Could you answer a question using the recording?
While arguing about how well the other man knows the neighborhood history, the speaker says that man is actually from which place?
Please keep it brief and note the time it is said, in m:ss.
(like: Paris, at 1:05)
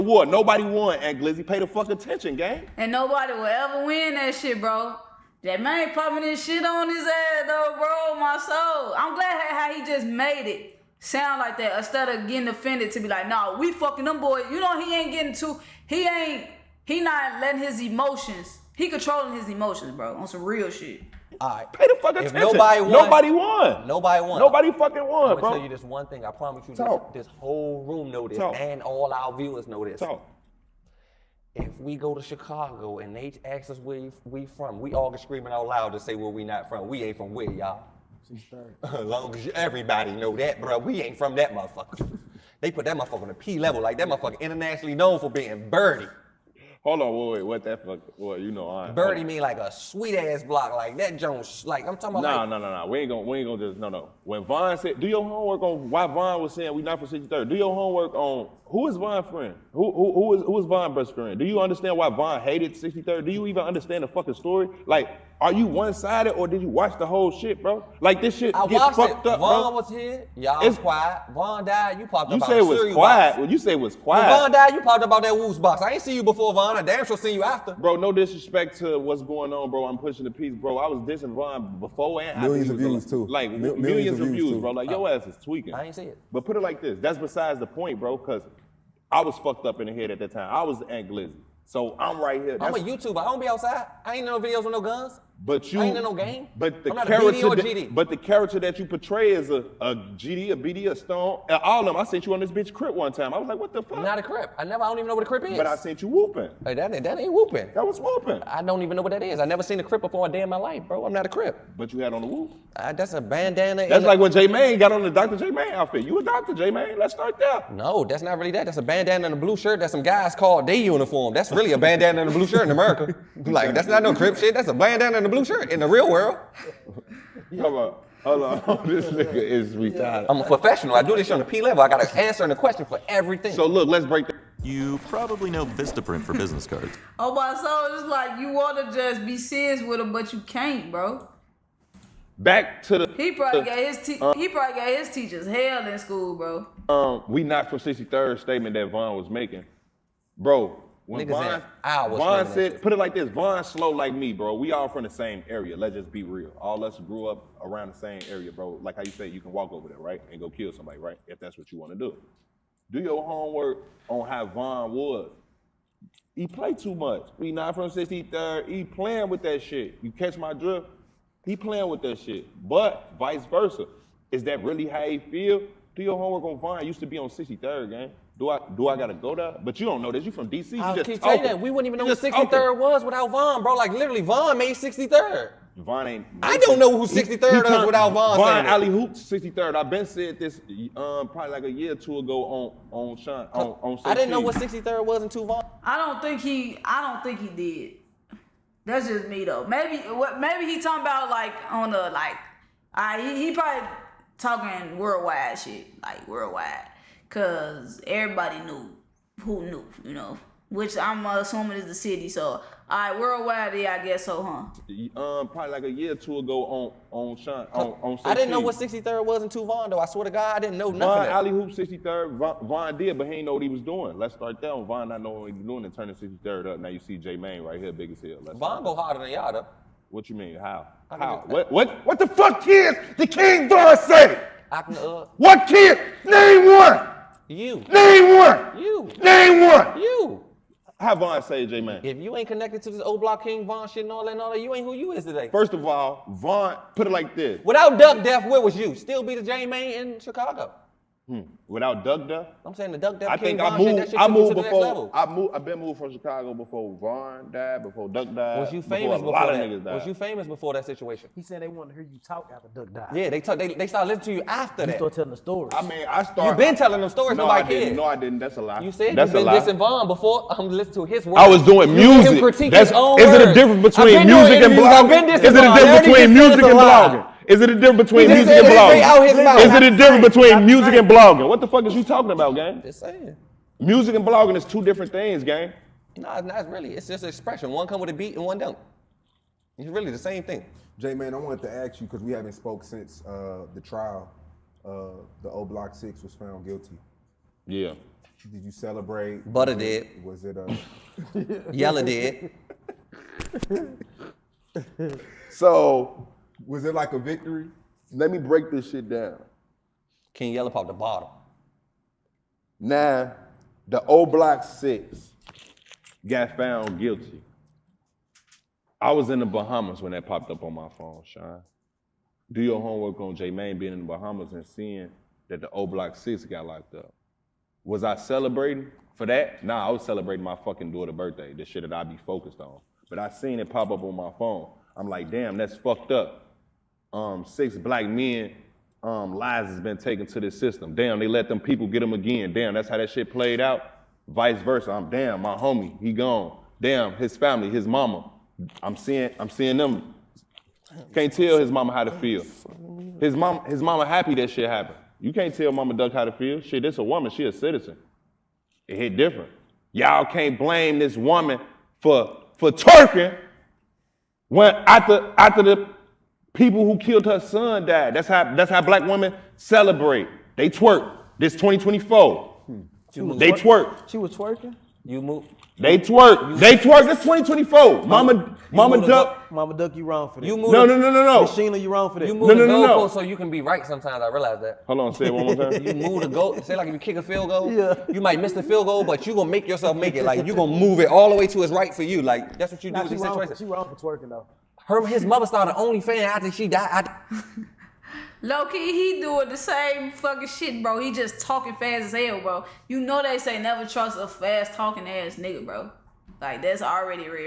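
DC, at 3:00.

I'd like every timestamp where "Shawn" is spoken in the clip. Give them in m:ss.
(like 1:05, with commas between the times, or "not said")
3:13, 3:37, 5:21.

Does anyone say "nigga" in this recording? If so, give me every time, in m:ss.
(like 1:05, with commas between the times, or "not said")
2:09, 2:31, 4:19, 6:45.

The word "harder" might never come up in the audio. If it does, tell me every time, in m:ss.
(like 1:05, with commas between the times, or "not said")
3:48.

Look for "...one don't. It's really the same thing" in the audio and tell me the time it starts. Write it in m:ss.
4:48.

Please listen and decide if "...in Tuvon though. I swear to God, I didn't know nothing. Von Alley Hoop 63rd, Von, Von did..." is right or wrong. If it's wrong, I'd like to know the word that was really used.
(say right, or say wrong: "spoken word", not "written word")
right.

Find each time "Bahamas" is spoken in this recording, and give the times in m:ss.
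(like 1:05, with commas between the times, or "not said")
5:19, 5:24.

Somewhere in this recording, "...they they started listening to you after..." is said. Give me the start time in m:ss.
4:23.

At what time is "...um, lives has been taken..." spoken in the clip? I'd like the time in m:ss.
5:39.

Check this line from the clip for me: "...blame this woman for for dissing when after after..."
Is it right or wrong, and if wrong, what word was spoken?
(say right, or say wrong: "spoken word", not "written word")
wrong: "twerking", not "dissing".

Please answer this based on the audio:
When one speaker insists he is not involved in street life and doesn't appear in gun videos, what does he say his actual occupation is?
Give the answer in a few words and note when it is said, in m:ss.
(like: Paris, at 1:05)
YouTuber, at 1:32.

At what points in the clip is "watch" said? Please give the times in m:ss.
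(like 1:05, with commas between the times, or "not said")
1:06.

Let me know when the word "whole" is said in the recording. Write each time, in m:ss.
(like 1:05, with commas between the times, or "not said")
0:27, 1:07.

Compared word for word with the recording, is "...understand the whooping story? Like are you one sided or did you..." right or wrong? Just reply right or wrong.
wrong.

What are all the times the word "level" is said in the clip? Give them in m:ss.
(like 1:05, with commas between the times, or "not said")
0:43, 2:11.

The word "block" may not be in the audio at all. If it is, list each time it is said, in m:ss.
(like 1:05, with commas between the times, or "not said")
0:50, 4:03, 4:55, 5:14, 5:25.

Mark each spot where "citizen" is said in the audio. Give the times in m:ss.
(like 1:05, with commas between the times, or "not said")
5:57.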